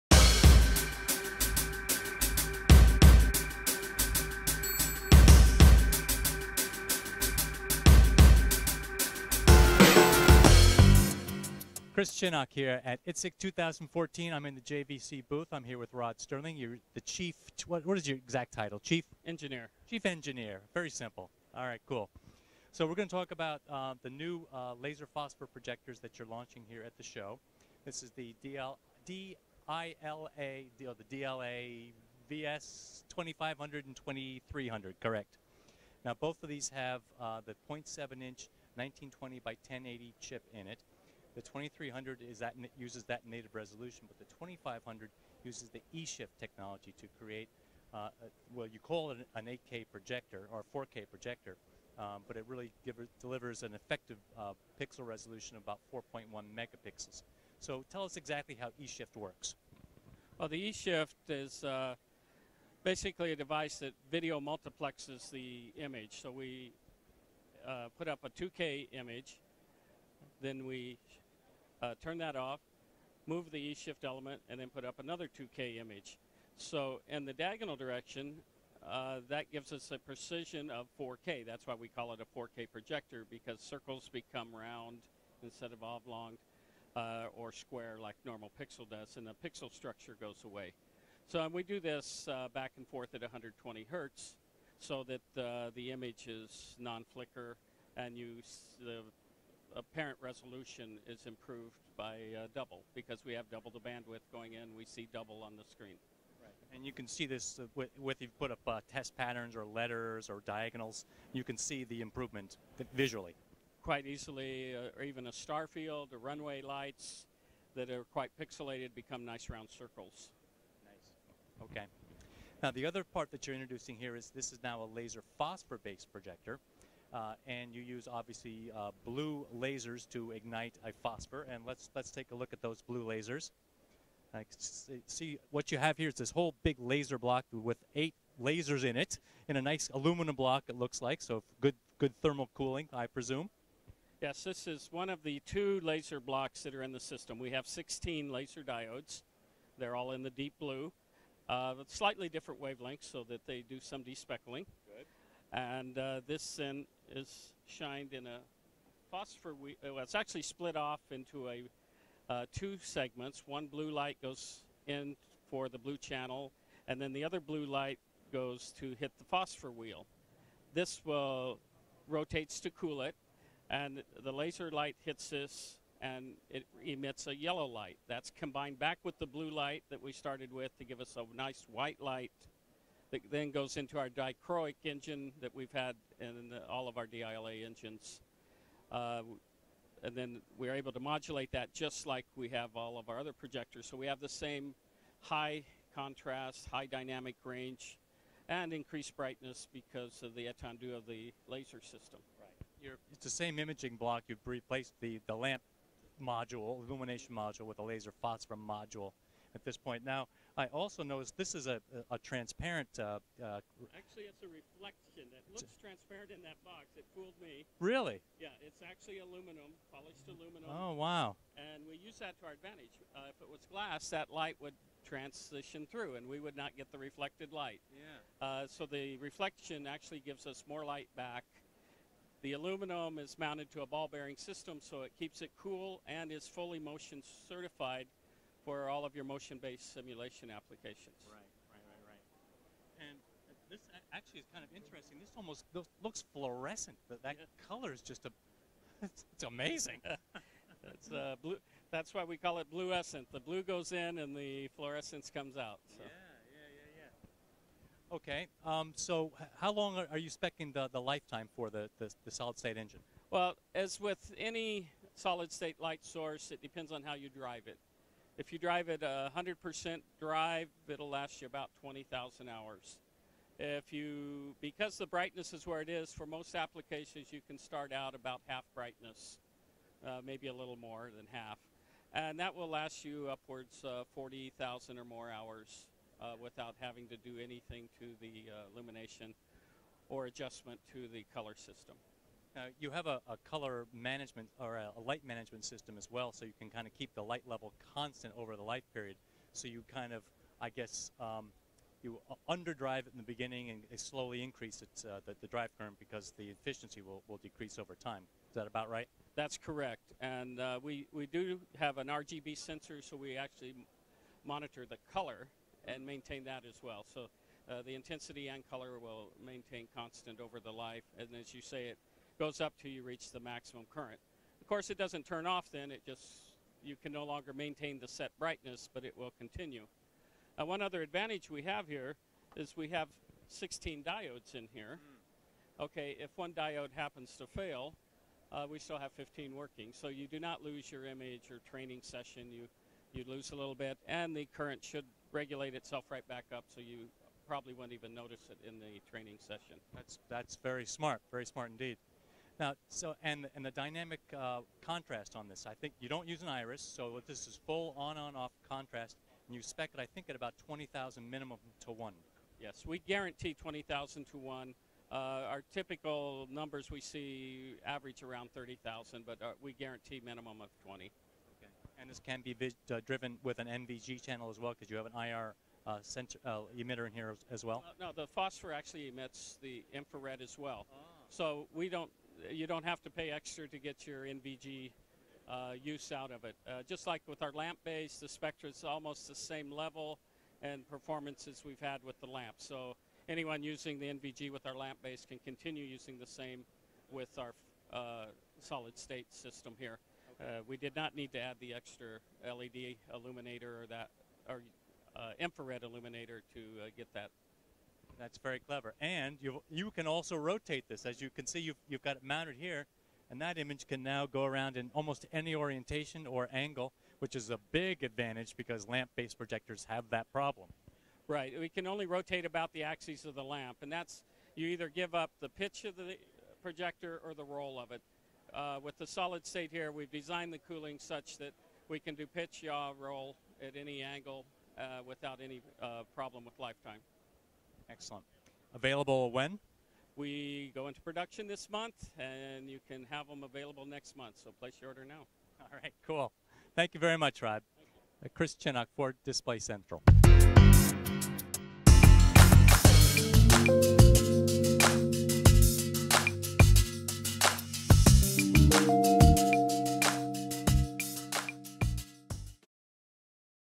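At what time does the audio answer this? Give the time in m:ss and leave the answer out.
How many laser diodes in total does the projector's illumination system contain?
2:27.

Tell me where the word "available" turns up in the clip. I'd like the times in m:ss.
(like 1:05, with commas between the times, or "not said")
7:18, 7:23.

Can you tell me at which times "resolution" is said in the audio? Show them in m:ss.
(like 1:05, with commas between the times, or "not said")
0:43, 0:55, 1:40.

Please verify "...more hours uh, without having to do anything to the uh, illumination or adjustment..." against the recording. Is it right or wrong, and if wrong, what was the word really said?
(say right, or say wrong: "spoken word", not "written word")
right.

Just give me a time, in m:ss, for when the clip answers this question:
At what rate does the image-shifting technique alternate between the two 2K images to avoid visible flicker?
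1:33.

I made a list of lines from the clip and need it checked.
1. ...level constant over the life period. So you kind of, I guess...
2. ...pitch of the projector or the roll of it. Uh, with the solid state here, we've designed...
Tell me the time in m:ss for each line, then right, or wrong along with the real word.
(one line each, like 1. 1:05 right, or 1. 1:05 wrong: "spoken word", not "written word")
1. 4:57 right
2. 7:05 right.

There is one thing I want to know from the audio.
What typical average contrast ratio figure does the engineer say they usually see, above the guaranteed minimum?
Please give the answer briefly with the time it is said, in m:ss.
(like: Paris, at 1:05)
30,000, at 6:08.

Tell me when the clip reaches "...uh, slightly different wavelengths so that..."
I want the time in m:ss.
2:31.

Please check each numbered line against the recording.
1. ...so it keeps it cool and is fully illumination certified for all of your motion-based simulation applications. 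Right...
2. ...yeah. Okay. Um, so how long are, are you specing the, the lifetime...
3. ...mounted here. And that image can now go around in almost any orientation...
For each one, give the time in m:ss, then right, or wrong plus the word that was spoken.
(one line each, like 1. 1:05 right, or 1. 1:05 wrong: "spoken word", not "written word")
1. 3:54 wrong: "motion", not "illumination"
2. 4:17 right
3. 6:52 right.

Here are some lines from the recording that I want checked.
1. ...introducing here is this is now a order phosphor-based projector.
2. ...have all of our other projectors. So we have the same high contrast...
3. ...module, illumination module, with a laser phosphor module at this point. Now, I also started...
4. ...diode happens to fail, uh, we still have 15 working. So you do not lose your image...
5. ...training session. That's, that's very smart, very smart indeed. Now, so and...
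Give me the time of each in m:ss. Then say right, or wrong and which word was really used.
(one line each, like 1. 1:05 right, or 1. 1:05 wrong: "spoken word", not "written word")
1. 2:03 wrong: "laser", not "order"
2. 3:12 right
3. 3:26 wrong: "noticed", not "started"
4. 5:36 right
5. 5:49 right.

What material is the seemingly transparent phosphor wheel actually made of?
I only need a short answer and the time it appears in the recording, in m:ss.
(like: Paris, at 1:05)
Polished aluminum, at 3:39.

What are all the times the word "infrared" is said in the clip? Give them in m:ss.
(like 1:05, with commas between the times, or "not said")
6:19, 6:45.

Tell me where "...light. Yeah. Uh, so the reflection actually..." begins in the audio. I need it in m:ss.
3:47.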